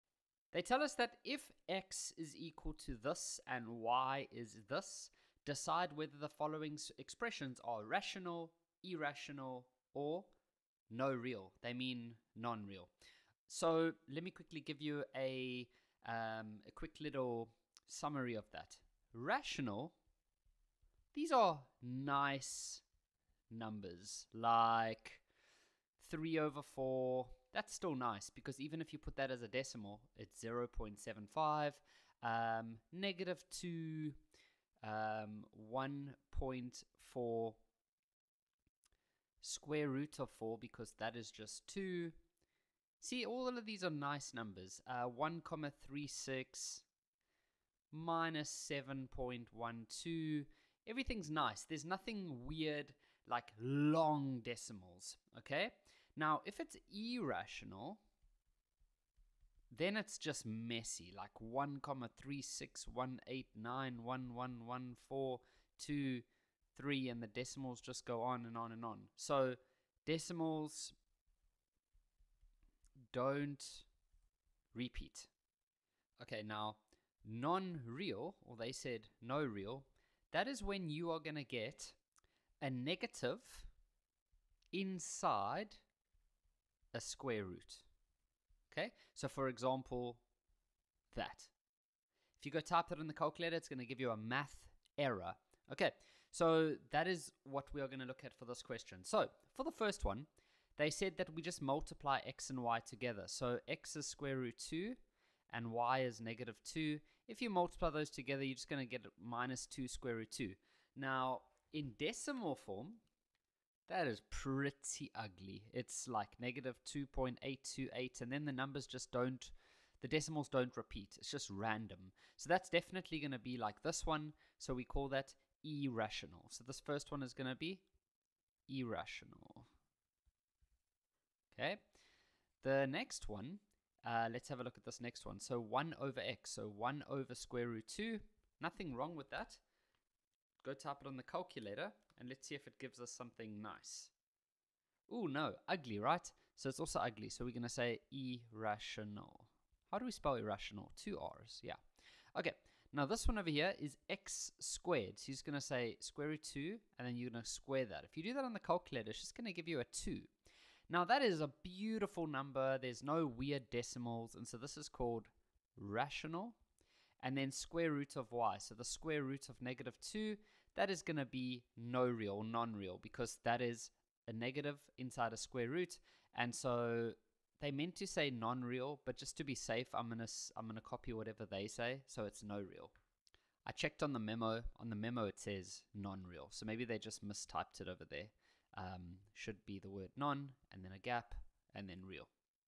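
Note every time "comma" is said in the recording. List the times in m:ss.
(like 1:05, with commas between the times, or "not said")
0:45, 1:01.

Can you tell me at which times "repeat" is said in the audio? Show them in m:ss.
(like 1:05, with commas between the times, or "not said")
1:14, 2:00.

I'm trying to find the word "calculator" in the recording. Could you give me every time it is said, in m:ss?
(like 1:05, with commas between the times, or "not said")
1:33, 2:21, 2:38.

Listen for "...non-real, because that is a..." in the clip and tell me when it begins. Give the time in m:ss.
2:52.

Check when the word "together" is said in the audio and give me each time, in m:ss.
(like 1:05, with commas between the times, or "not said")
1:42, 1:48.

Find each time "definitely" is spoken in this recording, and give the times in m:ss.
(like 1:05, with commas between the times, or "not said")
2:02.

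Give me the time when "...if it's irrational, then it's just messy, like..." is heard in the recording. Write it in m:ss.
0:56.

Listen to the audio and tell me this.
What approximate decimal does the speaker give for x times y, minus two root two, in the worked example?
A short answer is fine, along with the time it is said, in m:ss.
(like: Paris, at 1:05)
-2.828, at 1:56.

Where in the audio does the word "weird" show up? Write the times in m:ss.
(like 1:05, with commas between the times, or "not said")
0:52, 2:43.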